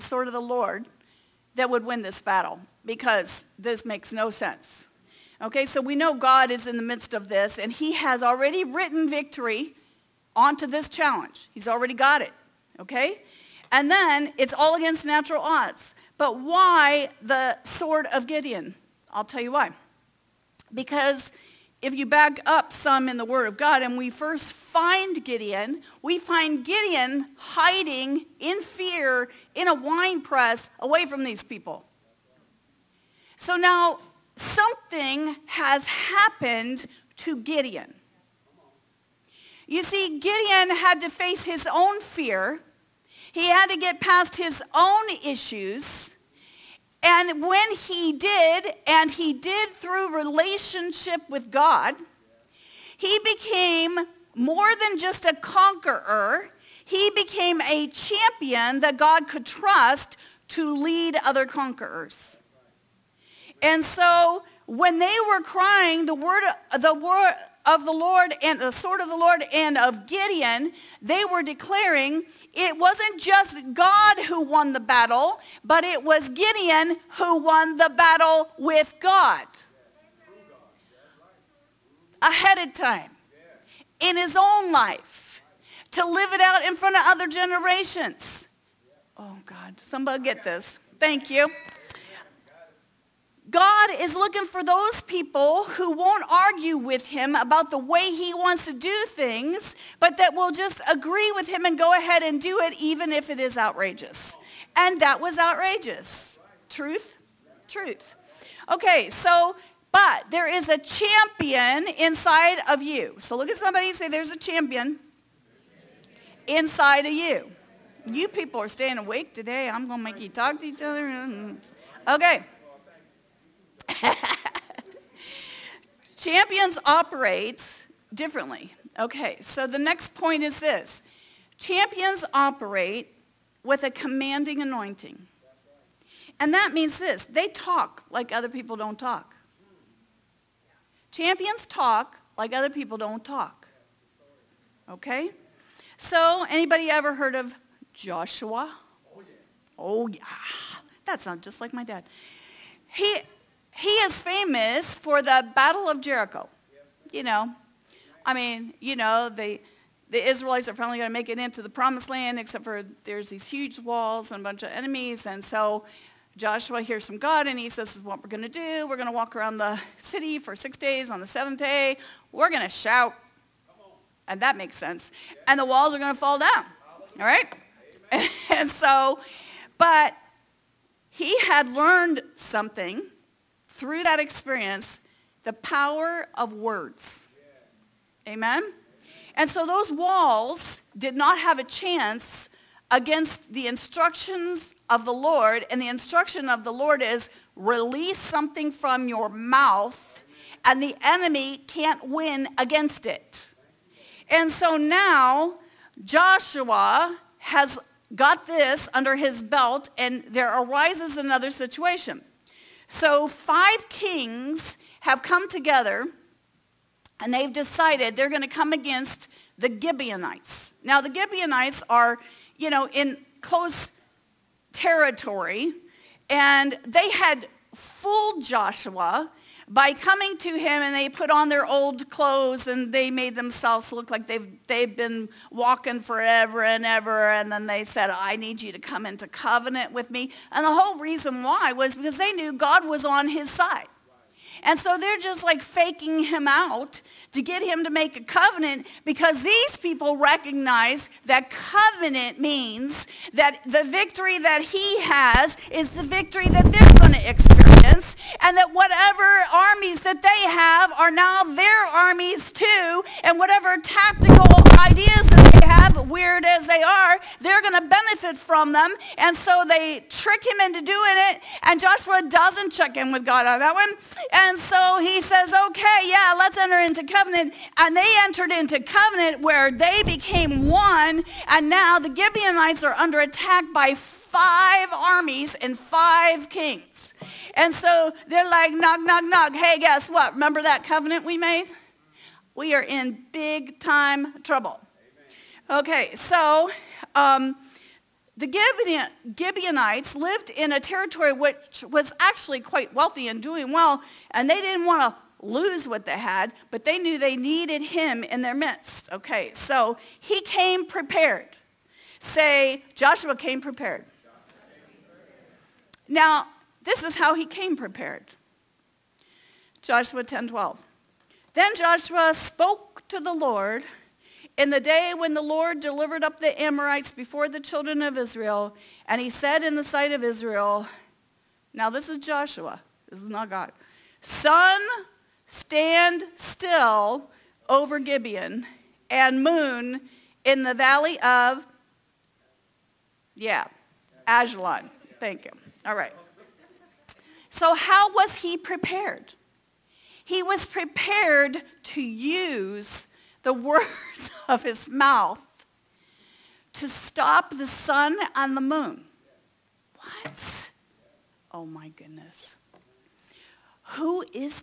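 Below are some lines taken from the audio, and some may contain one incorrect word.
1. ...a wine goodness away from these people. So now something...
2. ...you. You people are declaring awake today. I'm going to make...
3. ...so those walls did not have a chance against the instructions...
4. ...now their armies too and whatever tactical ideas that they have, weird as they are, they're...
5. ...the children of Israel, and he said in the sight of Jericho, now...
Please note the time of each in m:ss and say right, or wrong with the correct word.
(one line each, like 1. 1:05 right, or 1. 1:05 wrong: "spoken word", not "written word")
1. 0:29 wrong: "press", not "goodness"
2. 1:57 wrong: "staying", not "declaring"
3. 3:09 right
4. 4:21 right
5. 5:27 wrong: "Israel", not "Jericho".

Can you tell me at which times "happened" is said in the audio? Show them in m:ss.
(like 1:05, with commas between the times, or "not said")
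0:35.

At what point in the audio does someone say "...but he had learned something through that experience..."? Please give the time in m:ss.
2:59.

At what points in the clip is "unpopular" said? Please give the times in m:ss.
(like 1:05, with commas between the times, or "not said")
not said.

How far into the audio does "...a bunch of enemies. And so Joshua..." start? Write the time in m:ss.
2:44.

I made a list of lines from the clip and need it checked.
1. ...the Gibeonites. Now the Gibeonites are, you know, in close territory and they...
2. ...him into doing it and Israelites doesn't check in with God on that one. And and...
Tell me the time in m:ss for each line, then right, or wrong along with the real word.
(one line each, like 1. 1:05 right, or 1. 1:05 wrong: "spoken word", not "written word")
1. 3:39 right
2. 4:30 wrong: "Joshua", not "Israelites".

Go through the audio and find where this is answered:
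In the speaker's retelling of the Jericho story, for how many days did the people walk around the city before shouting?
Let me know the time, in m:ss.
2:50.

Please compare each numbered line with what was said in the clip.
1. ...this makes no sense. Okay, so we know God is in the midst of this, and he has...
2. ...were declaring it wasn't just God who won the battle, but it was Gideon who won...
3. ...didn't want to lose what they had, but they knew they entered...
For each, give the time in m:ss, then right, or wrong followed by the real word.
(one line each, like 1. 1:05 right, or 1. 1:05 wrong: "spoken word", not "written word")
1. 0:03 right
2. 1:11 right
3. 5:04 wrong: "needed", not "entered".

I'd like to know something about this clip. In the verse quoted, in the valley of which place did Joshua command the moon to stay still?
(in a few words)
Ajalon.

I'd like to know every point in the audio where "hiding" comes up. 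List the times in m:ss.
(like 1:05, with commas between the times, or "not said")
0:27.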